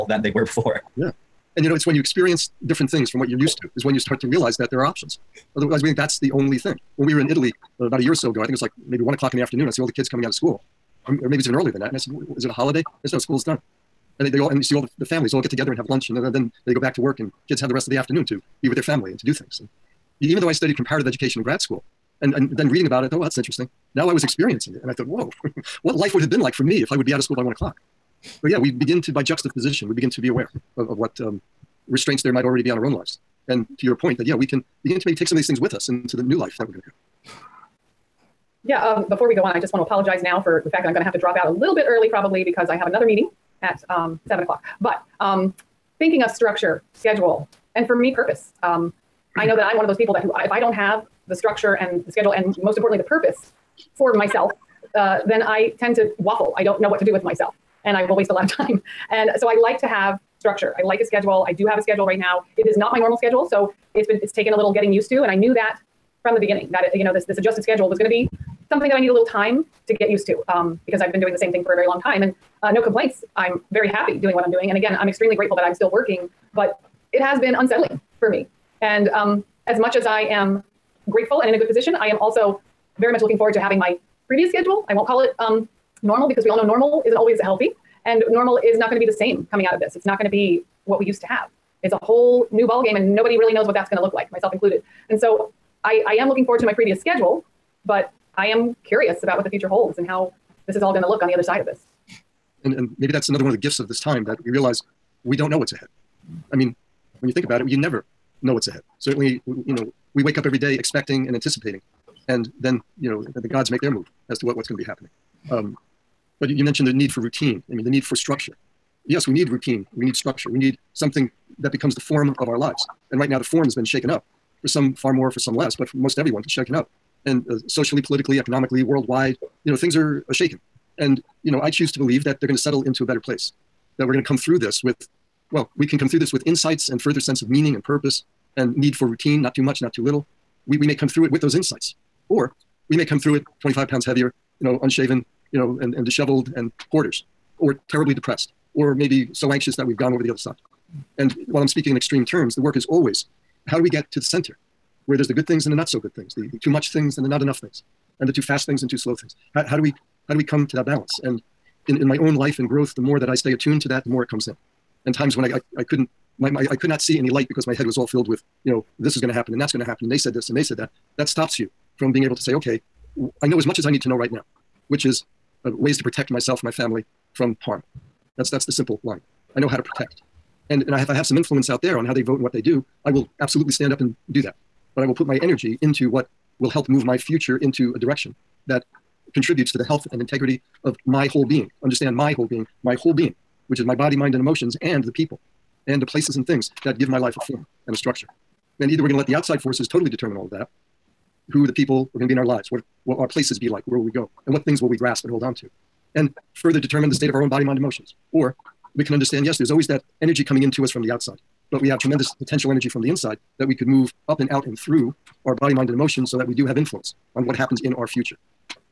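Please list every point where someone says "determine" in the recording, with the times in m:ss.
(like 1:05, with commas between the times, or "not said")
3:20, 3:26.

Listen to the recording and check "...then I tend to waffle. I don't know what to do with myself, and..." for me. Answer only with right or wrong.
right.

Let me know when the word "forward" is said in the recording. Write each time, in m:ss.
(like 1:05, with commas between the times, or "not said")
1:23, 1:36.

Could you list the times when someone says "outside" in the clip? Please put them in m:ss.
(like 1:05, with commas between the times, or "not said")
3:19, 3:31.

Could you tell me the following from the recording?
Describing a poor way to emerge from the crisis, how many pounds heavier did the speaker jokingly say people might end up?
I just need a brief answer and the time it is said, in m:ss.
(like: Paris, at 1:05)
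25, at 2:23.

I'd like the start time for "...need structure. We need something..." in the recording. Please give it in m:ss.
2:00.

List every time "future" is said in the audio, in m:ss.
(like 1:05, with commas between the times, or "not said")
1:39, 3:07, 3:38.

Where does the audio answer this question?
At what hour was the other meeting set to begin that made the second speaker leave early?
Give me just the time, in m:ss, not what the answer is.
0:44.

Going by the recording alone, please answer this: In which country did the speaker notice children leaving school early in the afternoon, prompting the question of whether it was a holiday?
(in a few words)
Italy.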